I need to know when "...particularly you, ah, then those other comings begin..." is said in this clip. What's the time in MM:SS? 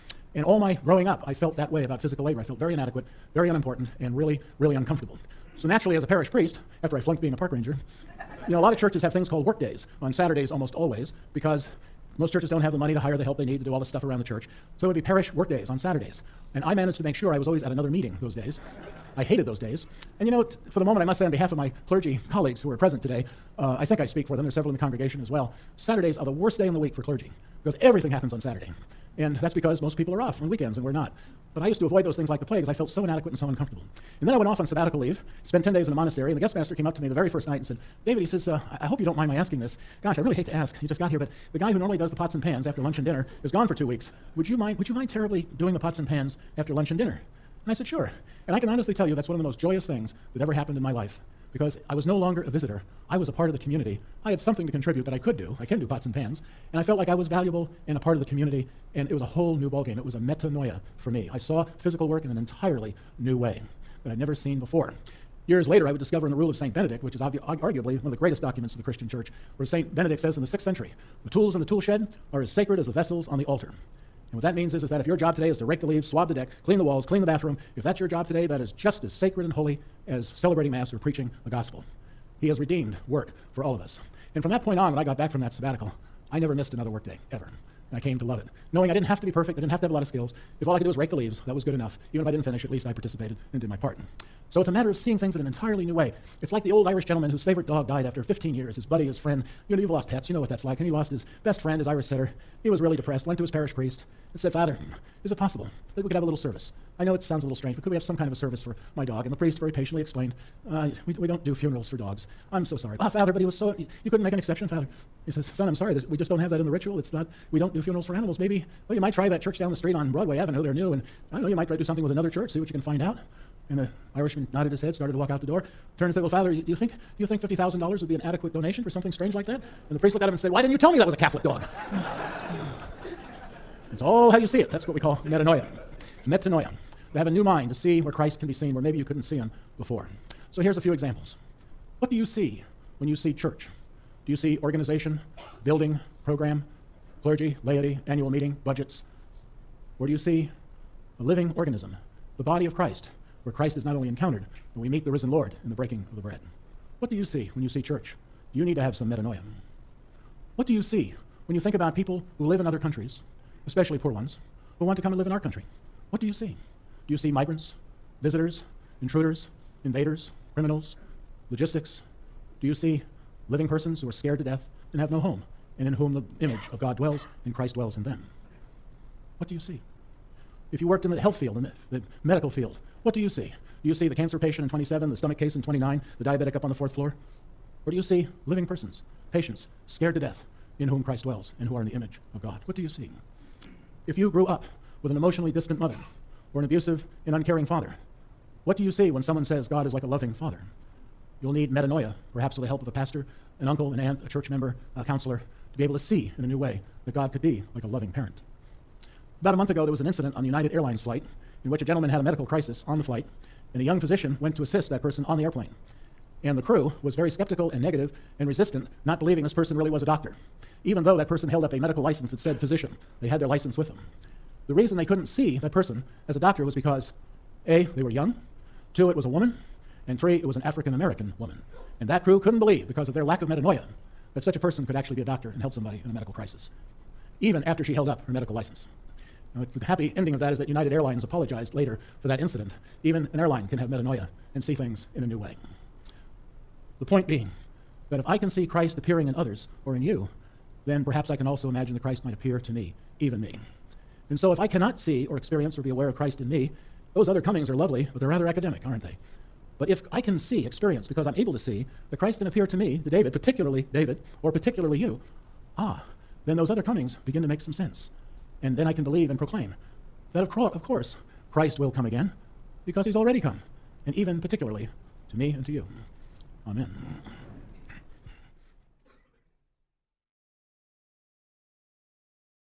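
04:24.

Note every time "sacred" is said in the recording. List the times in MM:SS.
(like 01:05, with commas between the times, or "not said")
01:12, 01:19.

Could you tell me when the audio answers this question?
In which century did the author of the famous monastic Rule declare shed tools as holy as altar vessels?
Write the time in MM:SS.
01:10.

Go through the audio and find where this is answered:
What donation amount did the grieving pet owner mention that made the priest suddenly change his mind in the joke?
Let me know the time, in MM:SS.
02:07.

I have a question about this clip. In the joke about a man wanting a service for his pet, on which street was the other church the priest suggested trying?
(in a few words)
Broadway Avenue.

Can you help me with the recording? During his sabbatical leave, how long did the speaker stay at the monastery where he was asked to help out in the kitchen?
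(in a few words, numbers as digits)
10 days.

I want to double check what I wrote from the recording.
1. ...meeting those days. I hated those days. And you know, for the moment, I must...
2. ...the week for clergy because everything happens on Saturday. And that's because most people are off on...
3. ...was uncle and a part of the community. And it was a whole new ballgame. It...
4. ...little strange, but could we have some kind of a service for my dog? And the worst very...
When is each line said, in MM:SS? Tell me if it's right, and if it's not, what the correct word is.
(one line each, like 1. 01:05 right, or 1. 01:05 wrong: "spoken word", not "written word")
1. 00:17 right
2. 00:26 right
3. 00:57 wrong: "valuable", not "uncle"
4. 01:47 wrong: "priest", not "worst".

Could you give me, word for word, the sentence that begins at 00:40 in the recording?
Gosh, I really hate to ask.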